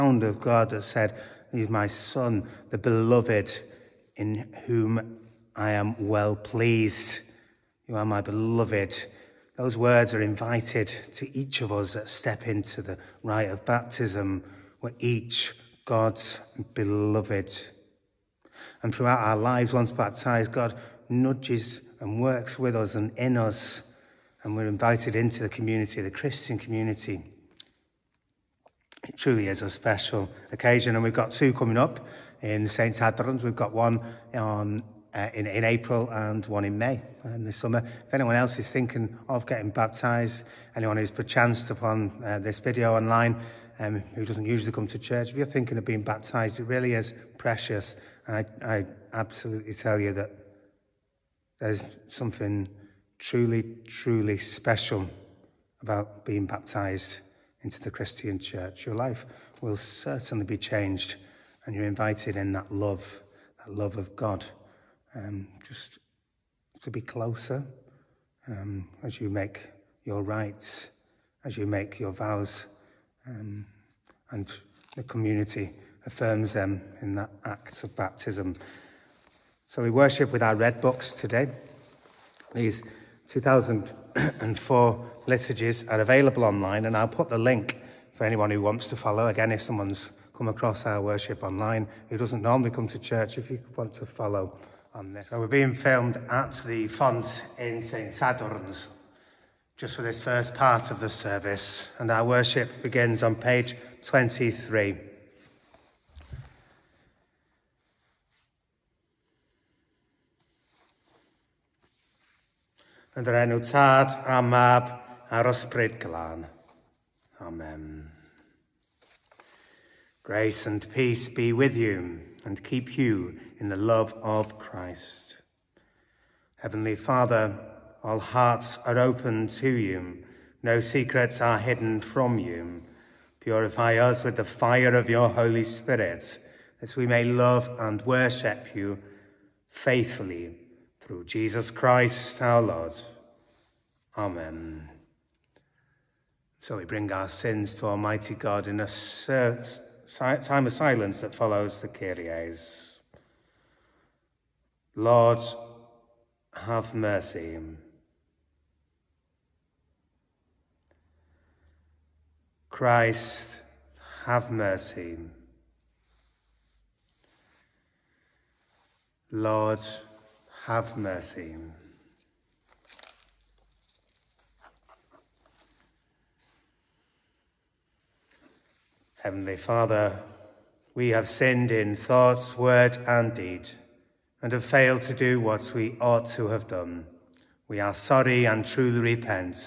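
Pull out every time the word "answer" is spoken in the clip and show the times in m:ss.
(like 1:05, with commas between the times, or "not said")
not said.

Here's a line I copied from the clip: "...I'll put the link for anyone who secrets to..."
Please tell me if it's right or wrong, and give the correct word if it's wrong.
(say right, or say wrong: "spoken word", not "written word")
wrong: "wants", not "secrets".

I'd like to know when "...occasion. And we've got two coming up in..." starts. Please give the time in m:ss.
0:30.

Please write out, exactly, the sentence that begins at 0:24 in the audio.
And we're invited into the community, the Christian community.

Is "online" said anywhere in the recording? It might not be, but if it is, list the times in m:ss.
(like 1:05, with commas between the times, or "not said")
0:42, 1:26, 1:31.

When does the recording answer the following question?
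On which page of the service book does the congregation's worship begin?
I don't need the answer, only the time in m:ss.
1:43.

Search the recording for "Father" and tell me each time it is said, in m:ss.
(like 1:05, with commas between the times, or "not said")
2:06, 2:59.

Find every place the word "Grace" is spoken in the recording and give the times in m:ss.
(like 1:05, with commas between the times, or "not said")
2:00.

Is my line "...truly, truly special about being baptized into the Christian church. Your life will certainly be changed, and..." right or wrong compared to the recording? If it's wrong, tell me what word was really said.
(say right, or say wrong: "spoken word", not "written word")
right.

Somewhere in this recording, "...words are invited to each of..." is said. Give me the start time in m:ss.
0:09.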